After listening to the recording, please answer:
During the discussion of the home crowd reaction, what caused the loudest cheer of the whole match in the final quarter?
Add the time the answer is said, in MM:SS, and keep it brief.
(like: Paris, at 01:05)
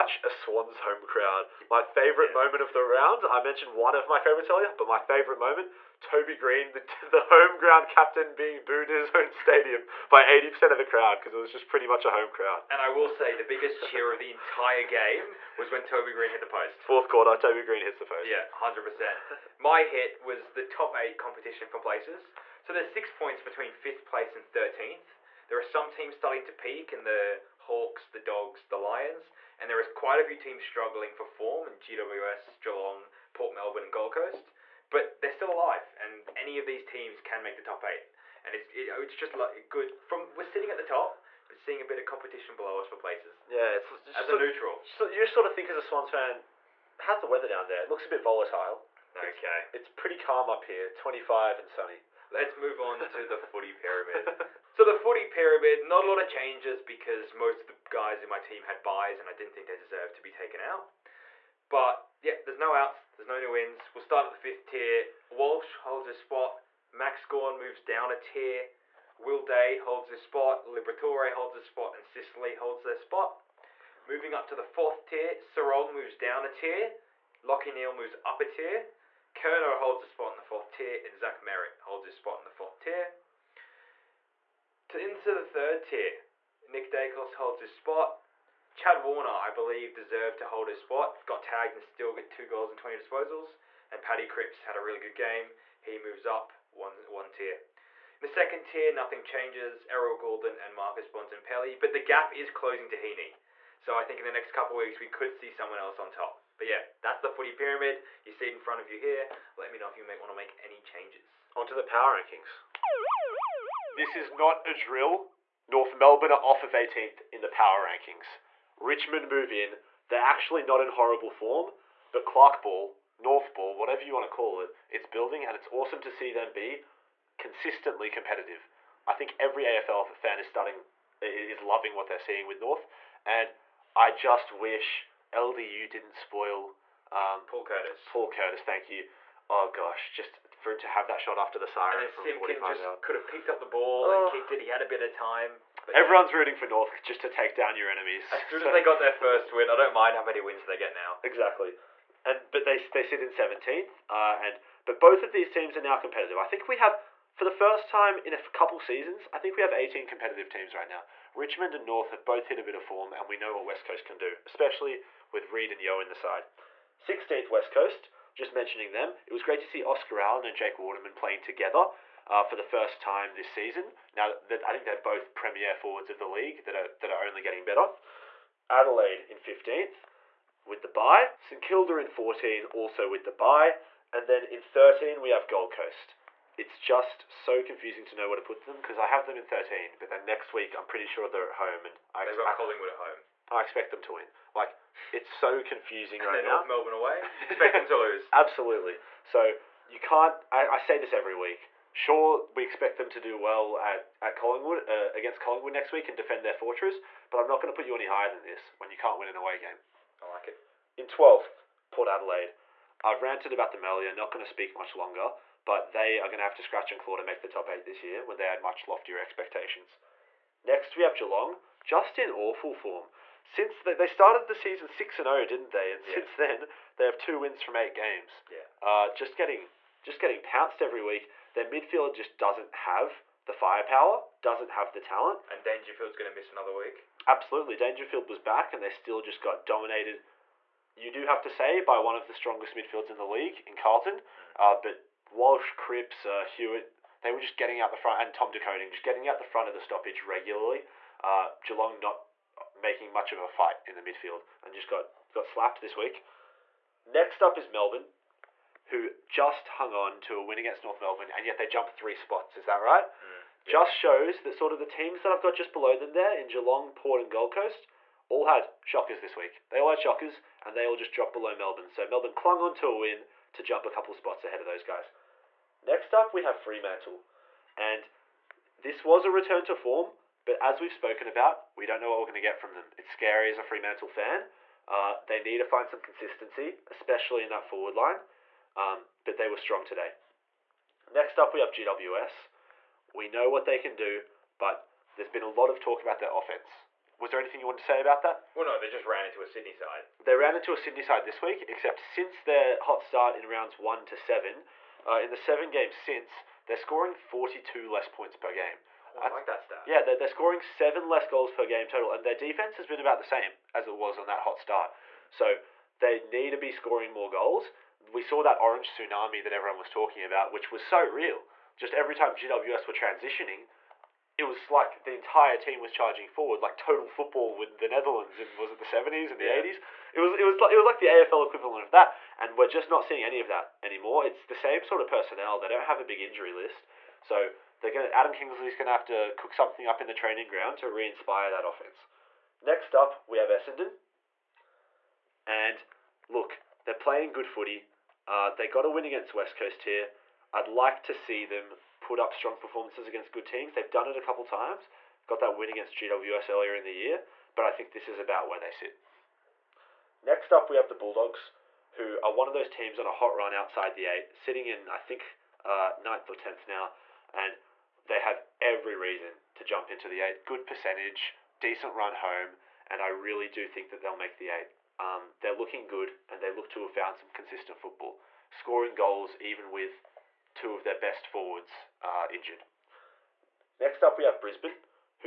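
Toby Greene hit the post, at 00:15.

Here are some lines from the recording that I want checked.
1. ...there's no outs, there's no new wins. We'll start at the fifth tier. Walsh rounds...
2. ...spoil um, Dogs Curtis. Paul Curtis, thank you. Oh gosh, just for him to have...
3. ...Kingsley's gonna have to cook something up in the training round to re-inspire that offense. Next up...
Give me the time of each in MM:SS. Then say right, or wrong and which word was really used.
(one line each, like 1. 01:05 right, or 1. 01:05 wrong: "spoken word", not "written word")
1. 01:02 wrong: "holds", not "rounds"
2. 02:16 wrong: "Paul", not "Dogs"
3. 05:38 wrong: "ground", not "round".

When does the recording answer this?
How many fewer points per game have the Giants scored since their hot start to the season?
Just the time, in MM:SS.
05:07.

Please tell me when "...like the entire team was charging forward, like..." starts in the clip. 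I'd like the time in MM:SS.
05:24.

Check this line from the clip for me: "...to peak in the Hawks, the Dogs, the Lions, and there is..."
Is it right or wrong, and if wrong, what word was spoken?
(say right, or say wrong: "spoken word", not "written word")
right.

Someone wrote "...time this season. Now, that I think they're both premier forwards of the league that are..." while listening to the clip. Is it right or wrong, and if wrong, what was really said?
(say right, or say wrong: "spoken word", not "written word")
right.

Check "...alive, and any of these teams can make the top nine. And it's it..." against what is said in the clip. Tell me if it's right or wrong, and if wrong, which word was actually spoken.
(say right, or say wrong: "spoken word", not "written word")
wrong: "eight", not "nine".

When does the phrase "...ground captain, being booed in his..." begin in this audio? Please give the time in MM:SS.
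00:07.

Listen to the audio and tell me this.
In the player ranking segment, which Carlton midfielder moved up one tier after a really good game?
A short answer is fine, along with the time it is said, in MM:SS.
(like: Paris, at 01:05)
Paddy Cripps, at 01:34.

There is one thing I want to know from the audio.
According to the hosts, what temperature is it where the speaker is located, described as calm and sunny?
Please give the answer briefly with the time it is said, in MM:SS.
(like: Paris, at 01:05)
25, at 00:50.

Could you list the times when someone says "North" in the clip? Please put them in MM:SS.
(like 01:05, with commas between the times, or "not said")
01:55, 02:03, 02:12, 02:26, 02:41, 03:16, 04:20.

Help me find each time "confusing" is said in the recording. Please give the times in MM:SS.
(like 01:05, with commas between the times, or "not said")
03:07, 03:15.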